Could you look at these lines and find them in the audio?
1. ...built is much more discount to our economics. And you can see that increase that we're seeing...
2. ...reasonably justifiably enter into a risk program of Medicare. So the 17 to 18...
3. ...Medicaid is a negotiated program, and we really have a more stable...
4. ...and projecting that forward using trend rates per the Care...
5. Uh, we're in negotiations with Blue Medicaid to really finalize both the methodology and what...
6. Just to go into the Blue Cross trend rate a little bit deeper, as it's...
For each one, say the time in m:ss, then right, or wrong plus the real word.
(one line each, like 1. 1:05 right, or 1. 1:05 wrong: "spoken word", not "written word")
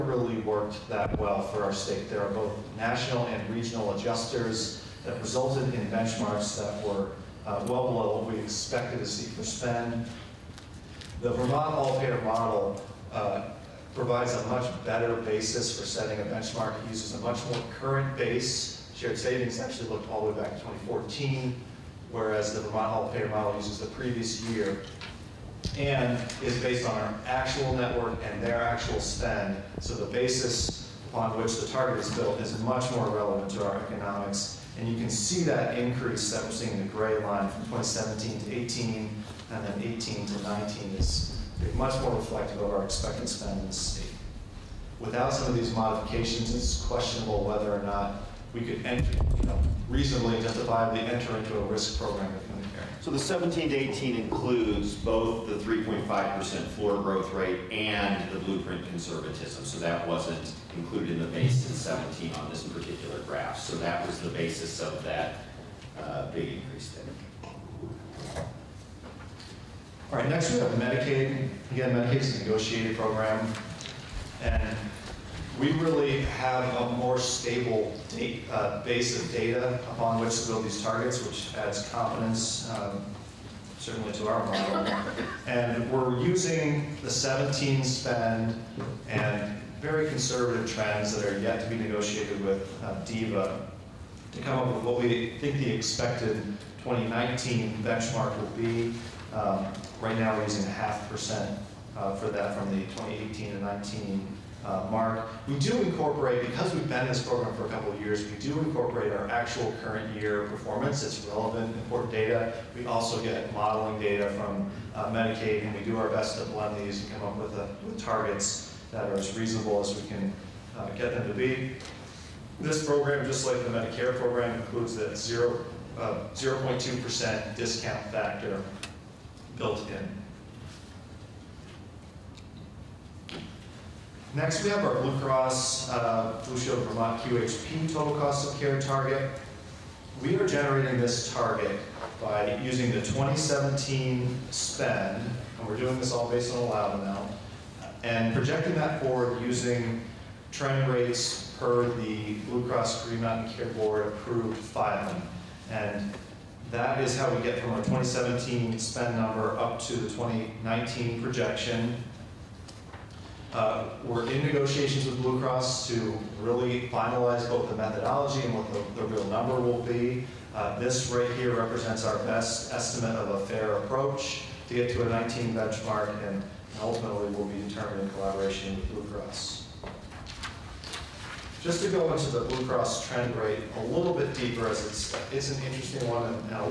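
1. 0:32 wrong: "relevant", not "discount"
2. 0:49 right
3. 1:11 right
4. 2:28 wrong: "Blue", not "Care"
5. 2:43 wrong: "Cross", not "Medicaid"
6. 3:01 right.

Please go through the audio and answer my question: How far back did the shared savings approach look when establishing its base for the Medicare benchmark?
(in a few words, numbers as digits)
2014.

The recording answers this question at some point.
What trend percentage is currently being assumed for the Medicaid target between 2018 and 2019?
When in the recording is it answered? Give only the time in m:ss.
1:40.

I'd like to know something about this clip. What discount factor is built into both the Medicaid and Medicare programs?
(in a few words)
0.2%.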